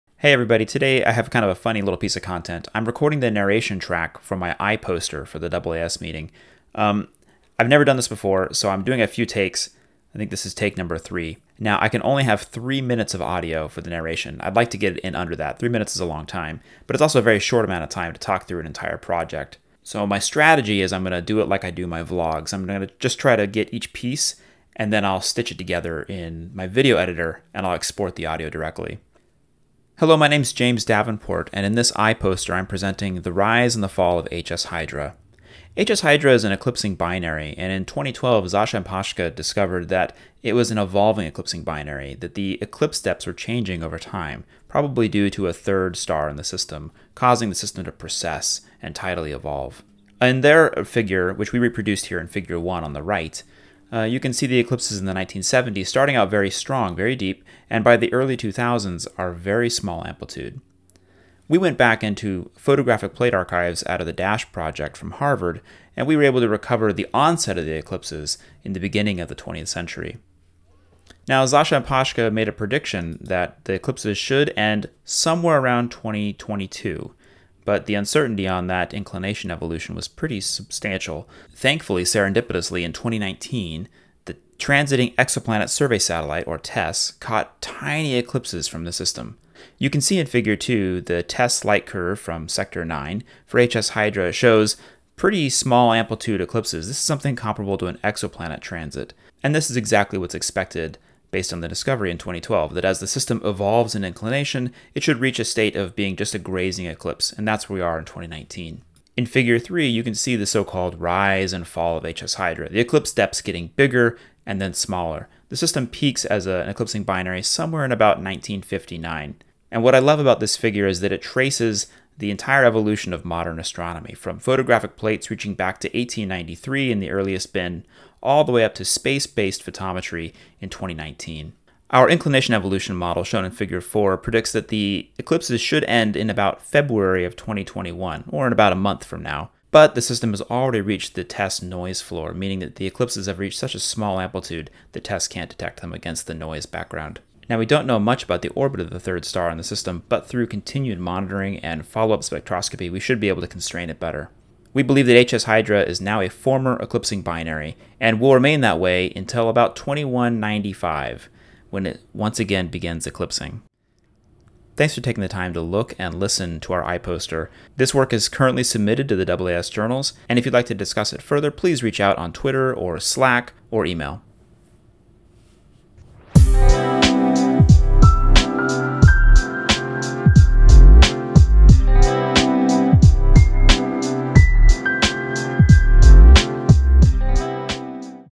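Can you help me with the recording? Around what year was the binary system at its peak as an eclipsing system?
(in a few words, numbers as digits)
1959.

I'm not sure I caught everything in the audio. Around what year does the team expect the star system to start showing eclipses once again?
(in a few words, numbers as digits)
2195.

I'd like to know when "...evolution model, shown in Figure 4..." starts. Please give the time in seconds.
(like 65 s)
132 s.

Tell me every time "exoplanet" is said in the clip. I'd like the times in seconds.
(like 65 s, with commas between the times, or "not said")
85 s, 98 s.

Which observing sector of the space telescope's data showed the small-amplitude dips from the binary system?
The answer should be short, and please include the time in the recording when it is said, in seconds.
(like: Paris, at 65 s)
Sector 9, at 92 s.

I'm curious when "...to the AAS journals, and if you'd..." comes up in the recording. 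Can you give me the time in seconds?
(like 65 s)
169 s.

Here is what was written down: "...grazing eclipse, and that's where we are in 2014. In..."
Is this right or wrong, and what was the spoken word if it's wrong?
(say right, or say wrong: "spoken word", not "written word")
wrong: "2019", not "2014".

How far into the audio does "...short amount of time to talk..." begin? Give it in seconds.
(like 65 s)
17 s.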